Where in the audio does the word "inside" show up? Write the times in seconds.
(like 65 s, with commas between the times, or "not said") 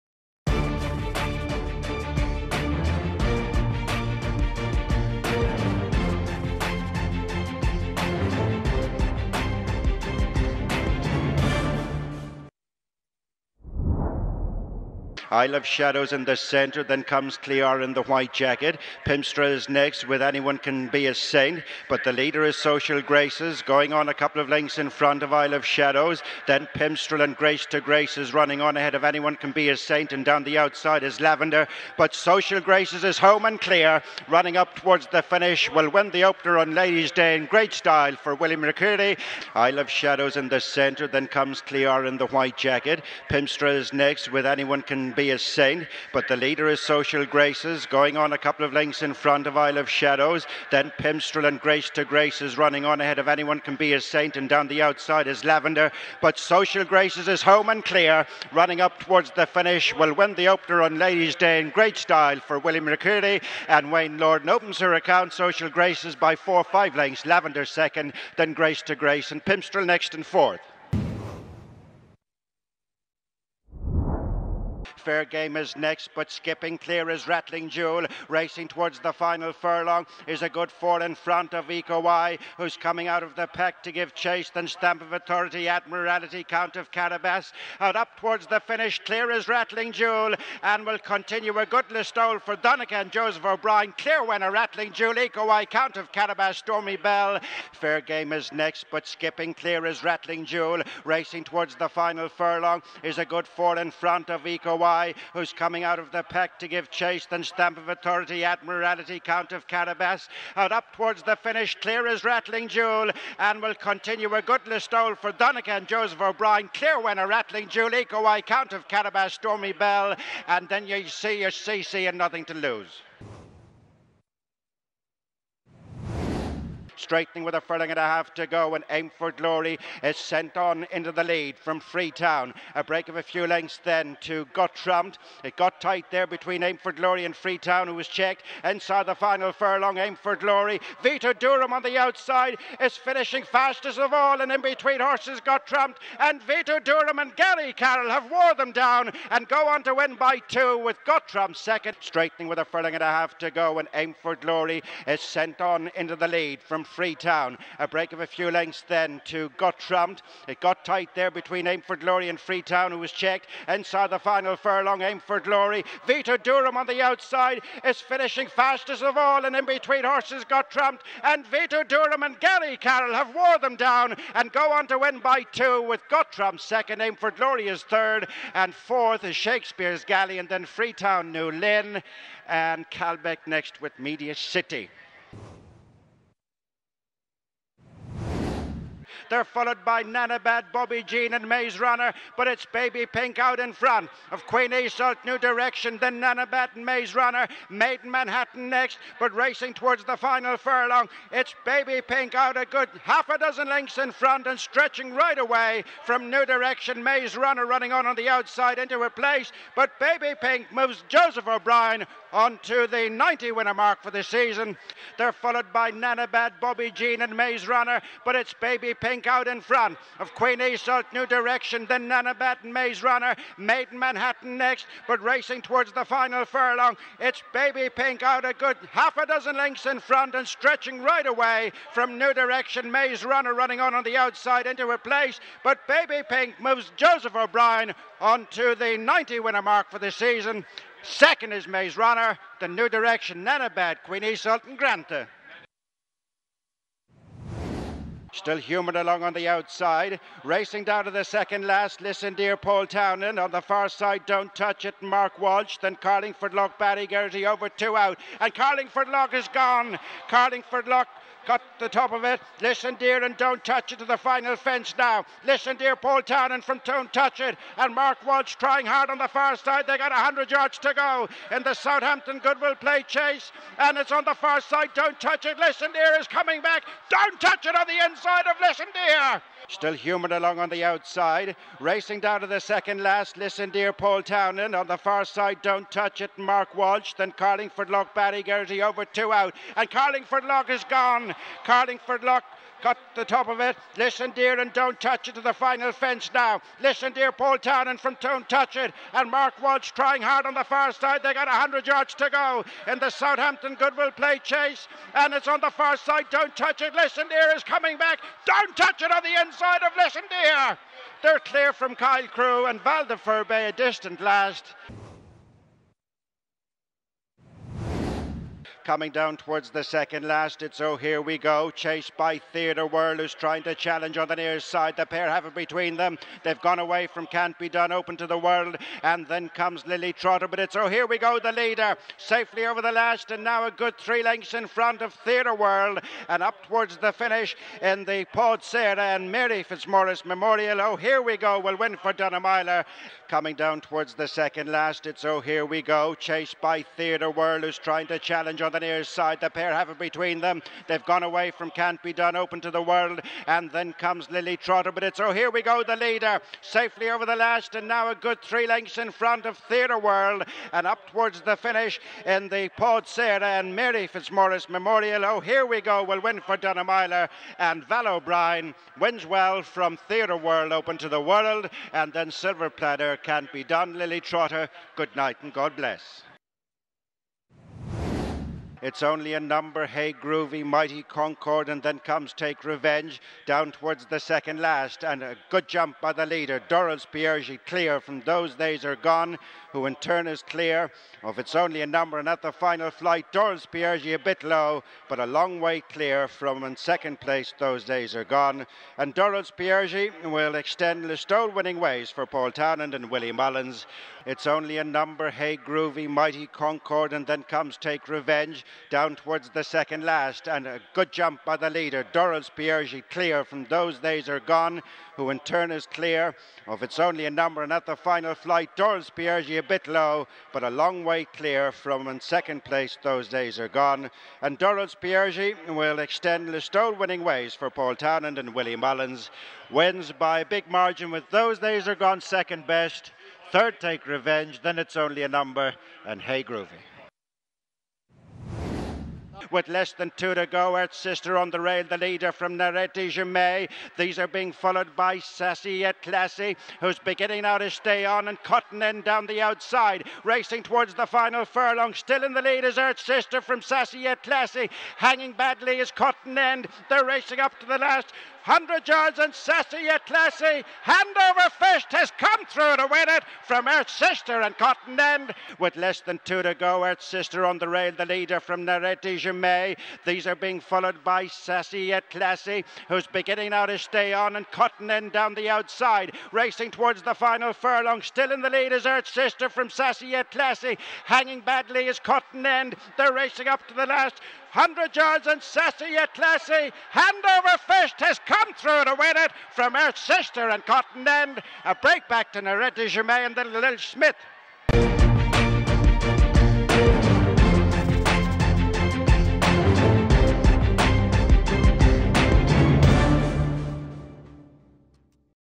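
138 s, 163 s, 278 s, 309 s.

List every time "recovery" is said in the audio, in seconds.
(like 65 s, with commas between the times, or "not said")
not said.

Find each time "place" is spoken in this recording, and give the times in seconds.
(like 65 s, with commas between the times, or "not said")
209 s, 234 s, 397 s, 422 s.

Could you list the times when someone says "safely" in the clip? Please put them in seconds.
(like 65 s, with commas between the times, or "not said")
332 s, 356 s.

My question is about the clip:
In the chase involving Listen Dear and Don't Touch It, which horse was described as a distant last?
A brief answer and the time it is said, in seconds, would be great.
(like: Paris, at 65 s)
Val de Furbay, at 312 s.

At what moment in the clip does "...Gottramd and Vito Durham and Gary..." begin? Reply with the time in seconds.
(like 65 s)
170 s.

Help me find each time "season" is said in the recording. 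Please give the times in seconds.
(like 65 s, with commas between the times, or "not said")
214 s, 240 s.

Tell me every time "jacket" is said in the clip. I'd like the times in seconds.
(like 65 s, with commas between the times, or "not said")
18 s, 42 s.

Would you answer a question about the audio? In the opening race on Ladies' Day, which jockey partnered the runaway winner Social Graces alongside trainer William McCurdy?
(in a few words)
Wayne Lordan.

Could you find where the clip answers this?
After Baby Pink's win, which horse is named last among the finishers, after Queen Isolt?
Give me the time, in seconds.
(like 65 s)
244 s.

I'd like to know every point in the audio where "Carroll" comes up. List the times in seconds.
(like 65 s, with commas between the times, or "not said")
147 s, 172 s.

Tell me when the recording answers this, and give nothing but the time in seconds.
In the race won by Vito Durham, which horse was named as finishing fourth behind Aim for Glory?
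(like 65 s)
179 s.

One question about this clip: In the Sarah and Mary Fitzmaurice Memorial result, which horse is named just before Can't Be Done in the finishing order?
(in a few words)
Silver Platter.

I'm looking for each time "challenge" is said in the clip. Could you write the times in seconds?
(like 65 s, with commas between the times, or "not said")
323 s, 348 s.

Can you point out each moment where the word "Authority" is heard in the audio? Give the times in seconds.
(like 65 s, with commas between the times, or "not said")
85 s, 107 s.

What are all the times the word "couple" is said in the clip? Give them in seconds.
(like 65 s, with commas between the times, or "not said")
24 s, 48 s.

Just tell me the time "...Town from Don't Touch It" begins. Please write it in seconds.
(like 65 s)
297 s.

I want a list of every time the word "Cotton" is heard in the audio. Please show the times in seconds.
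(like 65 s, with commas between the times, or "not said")
448 s, 455 s, 464 s, 474 s, 481 s, 490 s.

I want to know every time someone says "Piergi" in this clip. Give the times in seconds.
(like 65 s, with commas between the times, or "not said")
387 s, 393 s, 399 s, 412 s, 419 s, 425 s.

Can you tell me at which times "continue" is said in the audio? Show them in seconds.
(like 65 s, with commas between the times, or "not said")
90 s, 113 s.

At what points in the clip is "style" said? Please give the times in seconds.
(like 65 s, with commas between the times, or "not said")
37 s, 61 s.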